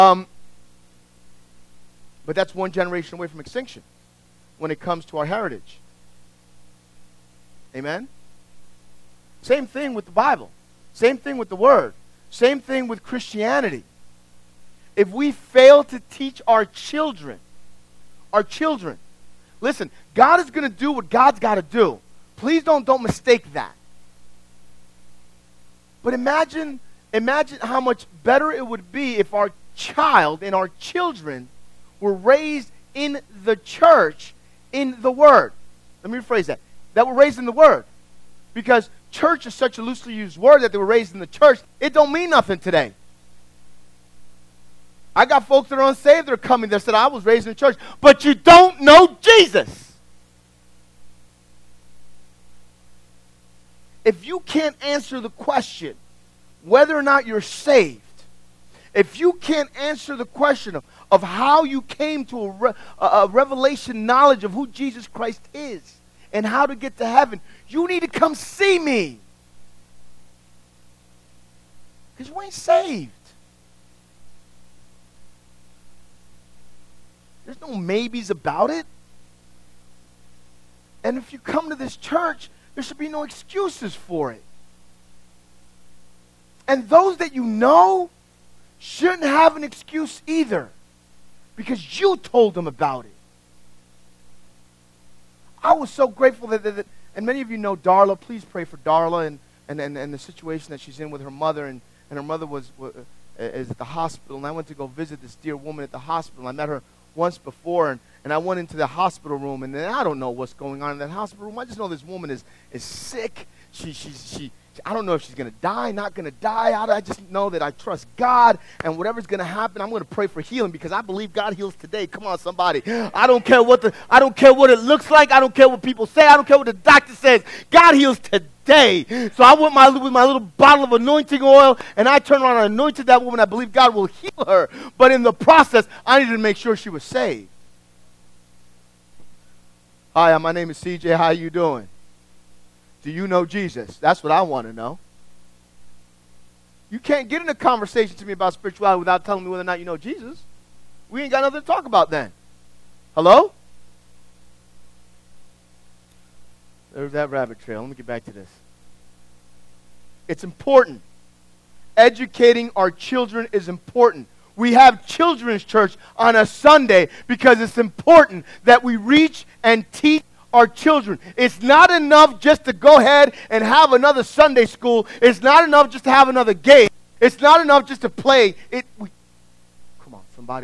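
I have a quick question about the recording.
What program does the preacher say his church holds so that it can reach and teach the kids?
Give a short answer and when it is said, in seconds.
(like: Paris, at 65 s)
Children's church, at 165 s.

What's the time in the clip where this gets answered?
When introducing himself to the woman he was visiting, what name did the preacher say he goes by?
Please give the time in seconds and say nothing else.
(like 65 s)
140 s.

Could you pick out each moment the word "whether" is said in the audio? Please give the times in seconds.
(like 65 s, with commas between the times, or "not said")
56 s, 149 s.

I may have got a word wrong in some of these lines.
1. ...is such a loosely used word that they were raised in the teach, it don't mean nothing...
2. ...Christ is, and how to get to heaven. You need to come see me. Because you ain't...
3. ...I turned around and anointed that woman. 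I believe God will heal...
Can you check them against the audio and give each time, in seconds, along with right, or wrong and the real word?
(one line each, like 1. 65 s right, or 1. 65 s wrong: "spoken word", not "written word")
1. 39 s wrong: "church", not "teach"
2. 65 s right
3. 132 s right.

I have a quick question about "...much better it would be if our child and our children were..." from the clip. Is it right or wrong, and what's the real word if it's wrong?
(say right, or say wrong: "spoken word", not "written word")
right.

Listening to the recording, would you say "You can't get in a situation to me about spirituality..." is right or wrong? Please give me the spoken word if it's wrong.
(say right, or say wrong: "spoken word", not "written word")
wrong: "conversation", not "situation".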